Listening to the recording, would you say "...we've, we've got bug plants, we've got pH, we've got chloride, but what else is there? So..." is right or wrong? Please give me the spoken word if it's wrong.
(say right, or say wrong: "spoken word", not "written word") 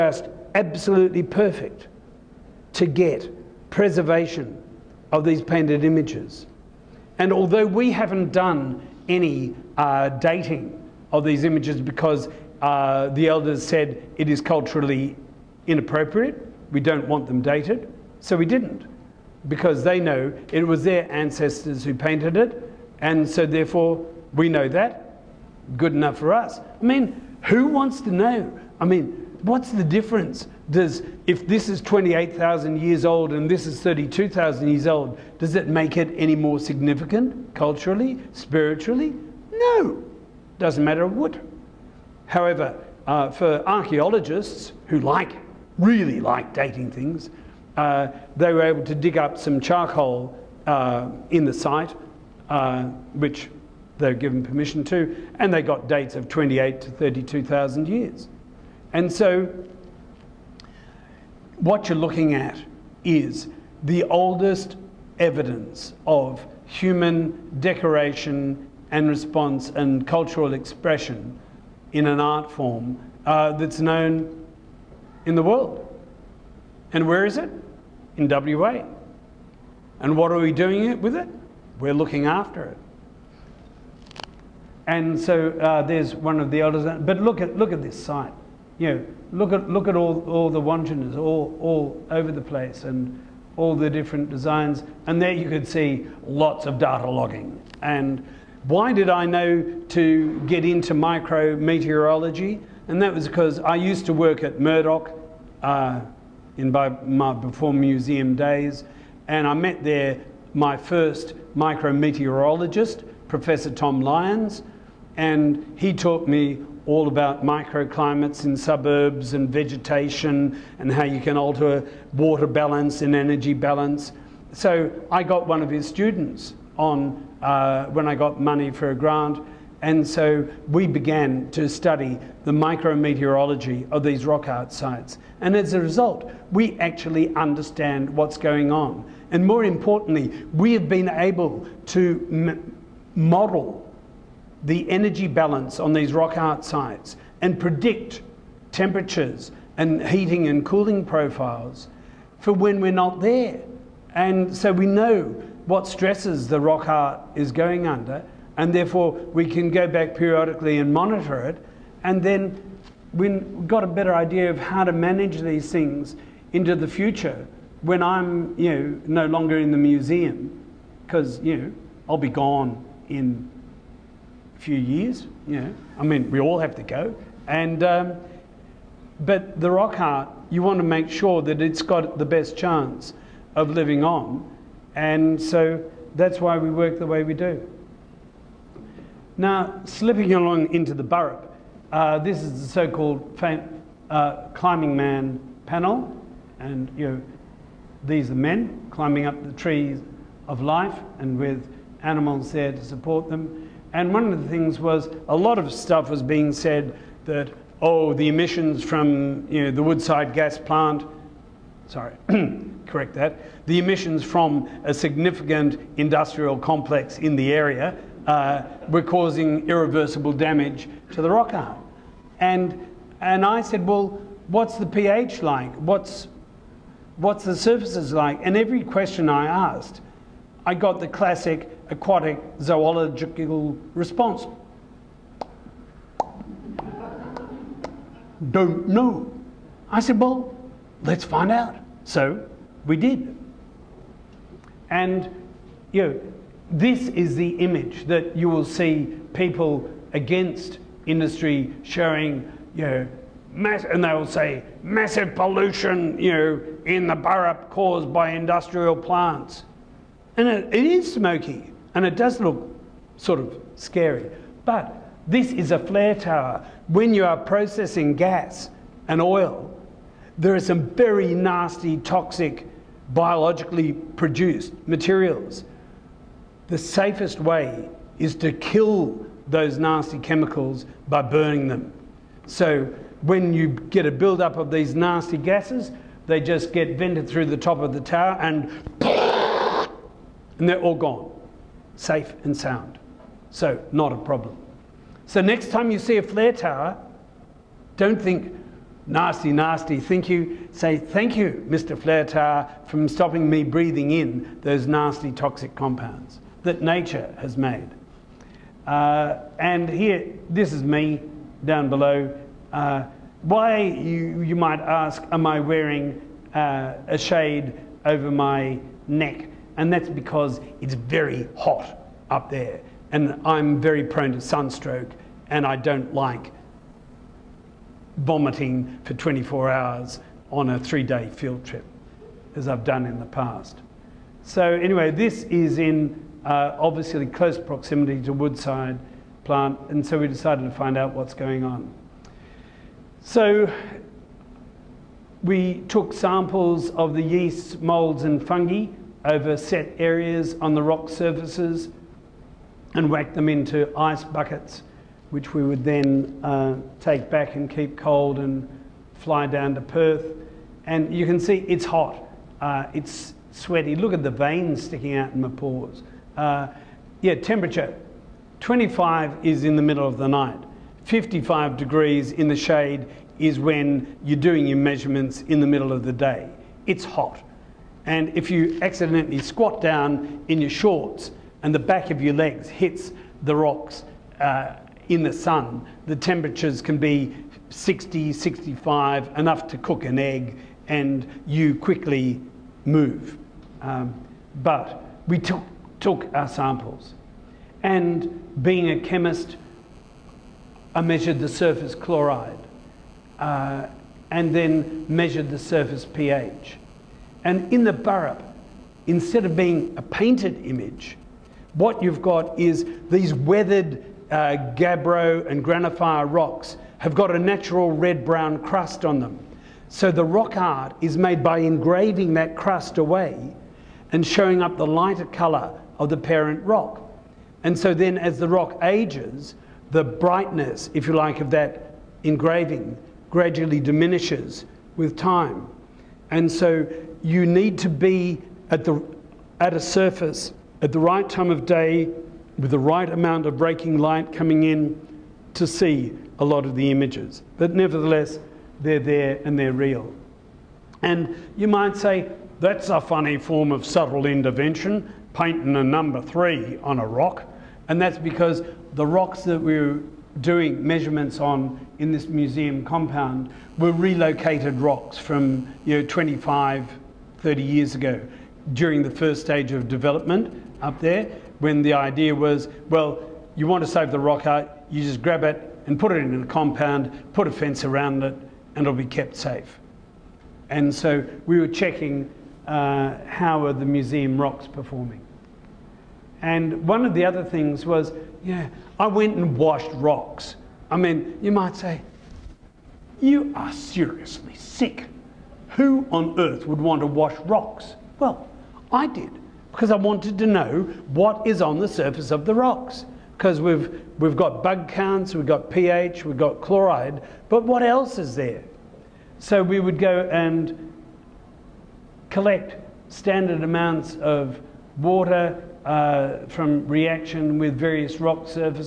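wrong: "counts", not "plants".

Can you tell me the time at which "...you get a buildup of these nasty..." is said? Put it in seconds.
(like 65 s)
283 s.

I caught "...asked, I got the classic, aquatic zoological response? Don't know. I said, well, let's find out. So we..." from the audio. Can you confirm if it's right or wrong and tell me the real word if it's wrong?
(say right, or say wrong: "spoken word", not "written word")
right.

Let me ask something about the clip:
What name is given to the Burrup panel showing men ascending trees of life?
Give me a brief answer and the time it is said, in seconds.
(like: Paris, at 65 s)
climbing man panel, at 194 s.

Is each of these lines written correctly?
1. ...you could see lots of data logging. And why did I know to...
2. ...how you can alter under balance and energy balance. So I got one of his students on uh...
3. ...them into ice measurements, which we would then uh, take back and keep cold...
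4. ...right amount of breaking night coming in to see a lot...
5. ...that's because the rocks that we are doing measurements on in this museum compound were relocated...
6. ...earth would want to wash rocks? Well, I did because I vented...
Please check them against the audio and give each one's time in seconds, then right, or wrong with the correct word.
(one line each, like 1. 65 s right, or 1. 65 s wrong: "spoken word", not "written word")
1. 95 s right
2. 120 s wrong: "water", not "under"
3. 353 s wrong: "buckets", not "measurements"
4. 442 s wrong: "light", not "night"
5. 458 s right
6. 496 s wrong: "wanted", not "vented".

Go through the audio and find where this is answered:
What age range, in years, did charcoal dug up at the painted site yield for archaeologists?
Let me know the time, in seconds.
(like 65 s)
56 s.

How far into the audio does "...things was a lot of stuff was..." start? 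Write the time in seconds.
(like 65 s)
204 s.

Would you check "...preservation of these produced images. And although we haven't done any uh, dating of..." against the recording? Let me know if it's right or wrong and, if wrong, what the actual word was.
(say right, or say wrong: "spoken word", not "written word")
wrong: "painted", not "produced".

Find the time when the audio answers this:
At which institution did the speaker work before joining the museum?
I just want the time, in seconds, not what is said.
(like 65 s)
104 s.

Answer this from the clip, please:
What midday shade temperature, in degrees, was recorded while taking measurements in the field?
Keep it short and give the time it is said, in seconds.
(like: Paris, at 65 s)
55, at 371 s.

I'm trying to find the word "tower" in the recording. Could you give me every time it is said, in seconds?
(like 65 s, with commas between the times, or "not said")
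266 s, 288 s, 296 s, 302 s.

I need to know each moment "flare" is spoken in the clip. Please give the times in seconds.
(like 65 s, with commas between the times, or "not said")
265 s, 296 s, 301 s.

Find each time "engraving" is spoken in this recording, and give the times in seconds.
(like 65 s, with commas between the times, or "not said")
421 s, 432 s.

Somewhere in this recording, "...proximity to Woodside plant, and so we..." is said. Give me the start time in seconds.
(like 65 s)
337 s.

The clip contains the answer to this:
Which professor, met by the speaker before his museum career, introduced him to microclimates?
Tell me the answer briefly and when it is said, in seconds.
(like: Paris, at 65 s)
Professor Tom Lyons, at 113 s.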